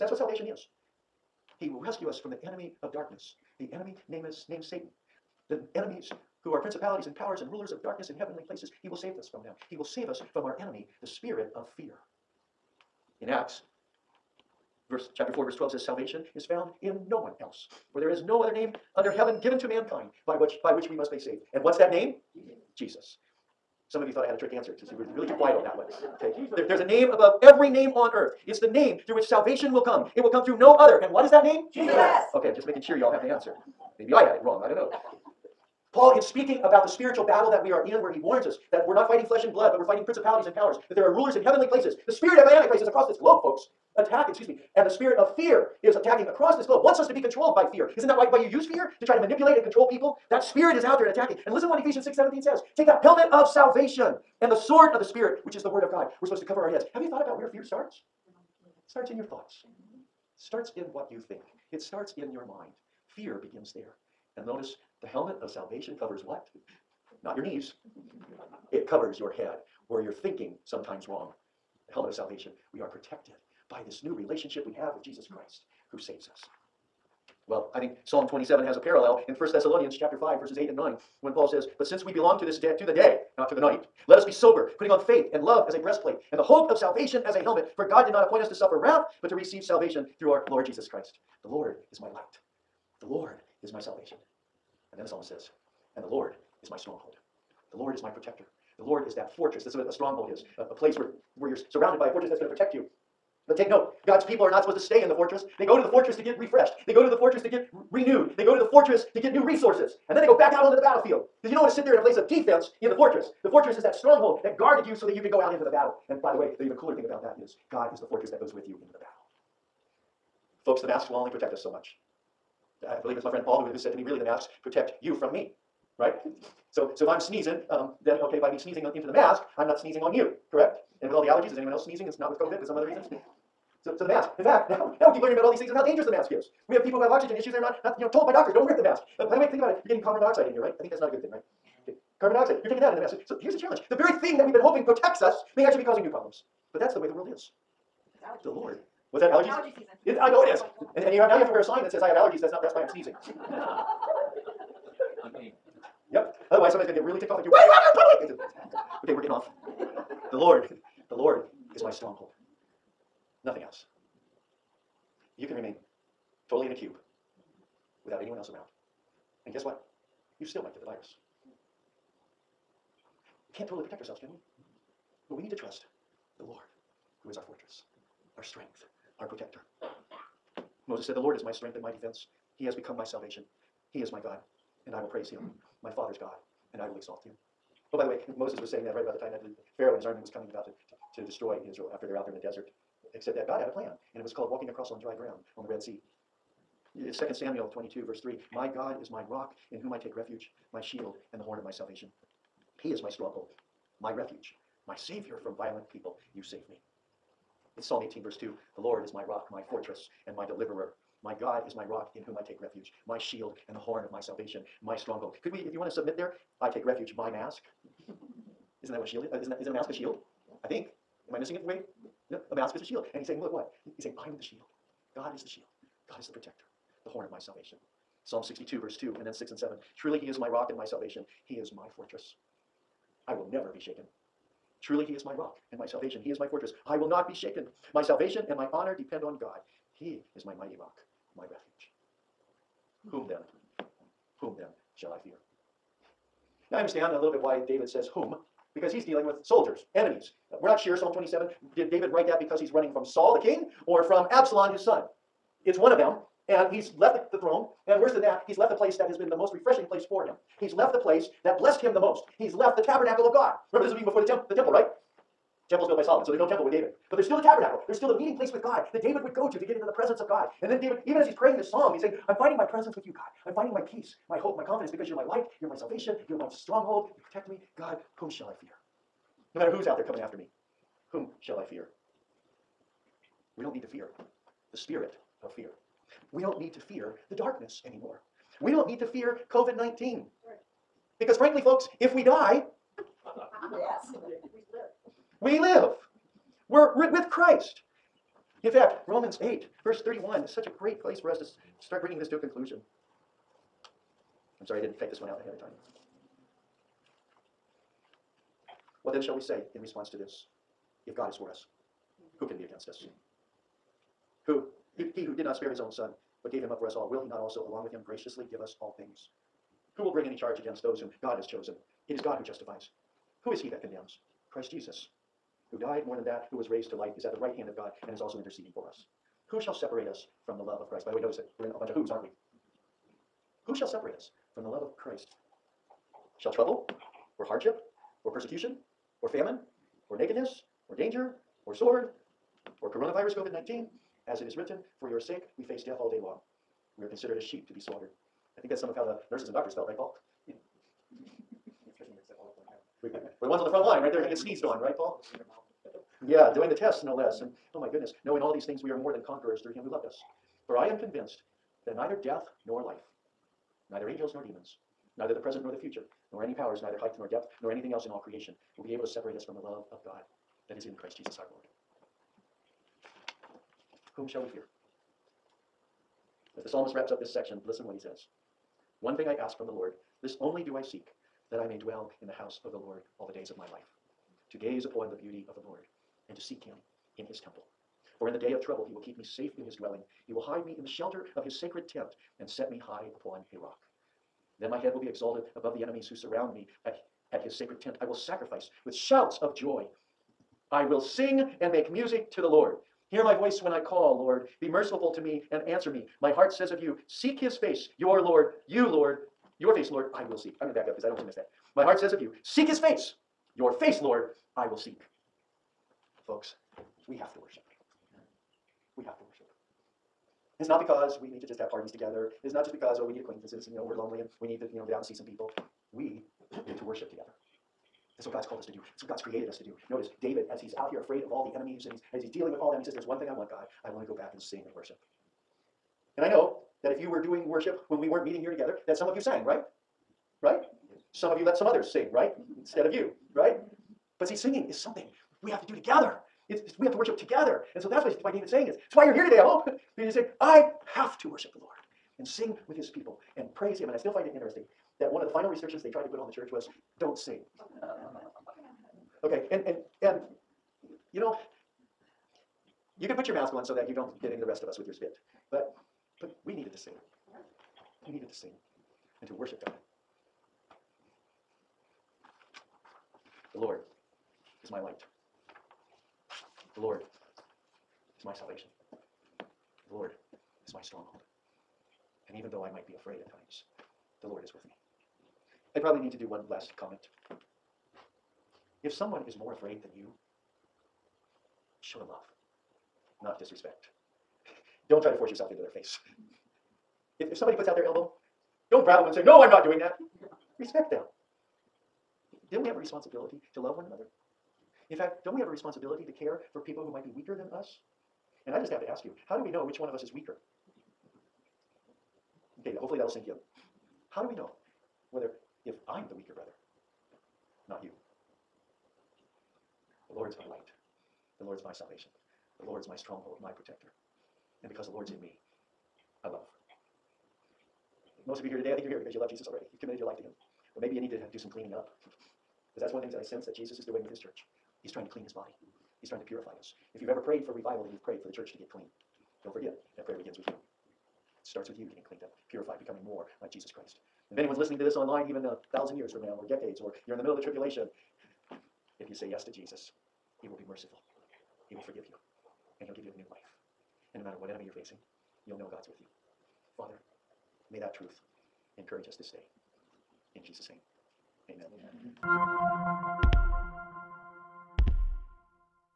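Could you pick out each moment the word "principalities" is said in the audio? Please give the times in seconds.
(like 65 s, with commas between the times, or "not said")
6 s, 40 s.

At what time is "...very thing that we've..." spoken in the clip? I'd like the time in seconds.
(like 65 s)
143 s.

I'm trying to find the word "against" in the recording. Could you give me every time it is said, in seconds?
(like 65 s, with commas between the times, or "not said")
312 s, 320 s.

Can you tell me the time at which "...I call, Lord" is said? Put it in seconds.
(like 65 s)
403 s.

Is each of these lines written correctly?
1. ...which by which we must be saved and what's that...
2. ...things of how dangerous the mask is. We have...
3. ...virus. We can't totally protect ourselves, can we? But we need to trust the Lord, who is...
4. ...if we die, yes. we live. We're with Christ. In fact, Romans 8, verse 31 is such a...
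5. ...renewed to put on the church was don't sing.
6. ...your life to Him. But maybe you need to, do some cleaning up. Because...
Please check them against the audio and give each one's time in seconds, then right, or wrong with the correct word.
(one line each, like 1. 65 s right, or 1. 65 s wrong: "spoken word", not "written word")
1. 20 s right
2. 135 s right
3. 170 s right
4. 292 s right
5. 455 s wrong: "tried", not "renewed"
6. 529 s right.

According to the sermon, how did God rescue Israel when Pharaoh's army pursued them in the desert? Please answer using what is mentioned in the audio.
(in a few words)
Walking across on dry ground.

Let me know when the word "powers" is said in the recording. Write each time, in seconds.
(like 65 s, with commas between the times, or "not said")
7 s, 40 s, 366 s.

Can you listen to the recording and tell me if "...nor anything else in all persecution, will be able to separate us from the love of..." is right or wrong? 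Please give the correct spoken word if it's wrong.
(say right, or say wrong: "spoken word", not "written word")
wrong: "creation", not "persecution".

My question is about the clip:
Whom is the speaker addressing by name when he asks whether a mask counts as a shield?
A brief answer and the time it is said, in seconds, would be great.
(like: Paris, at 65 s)
Wade, at 221 s.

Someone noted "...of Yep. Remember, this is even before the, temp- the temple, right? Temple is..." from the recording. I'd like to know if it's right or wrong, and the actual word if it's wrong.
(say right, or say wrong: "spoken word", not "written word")
wrong: "God", not "Yep".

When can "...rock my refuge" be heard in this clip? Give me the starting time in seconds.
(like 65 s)
240 s.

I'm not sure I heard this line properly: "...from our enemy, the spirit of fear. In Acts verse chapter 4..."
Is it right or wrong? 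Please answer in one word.
right.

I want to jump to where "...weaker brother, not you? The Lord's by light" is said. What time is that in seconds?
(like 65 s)
516 s.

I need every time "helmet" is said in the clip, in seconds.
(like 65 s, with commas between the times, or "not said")
53 s, 65 s, 71 s, 87 s.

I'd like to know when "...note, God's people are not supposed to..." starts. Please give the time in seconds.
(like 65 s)
103 s.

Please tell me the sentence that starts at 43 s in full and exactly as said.
Attack, excuse me, and the spirit of fear is attacking across this globe, wants us to be controlled by fear.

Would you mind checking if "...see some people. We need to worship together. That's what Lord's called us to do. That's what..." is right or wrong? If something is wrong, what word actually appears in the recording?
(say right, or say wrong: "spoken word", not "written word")
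wrong: "God", not "Lord".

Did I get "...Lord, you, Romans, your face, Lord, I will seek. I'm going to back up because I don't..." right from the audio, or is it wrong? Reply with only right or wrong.
wrong.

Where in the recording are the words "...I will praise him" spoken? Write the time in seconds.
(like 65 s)
184 s.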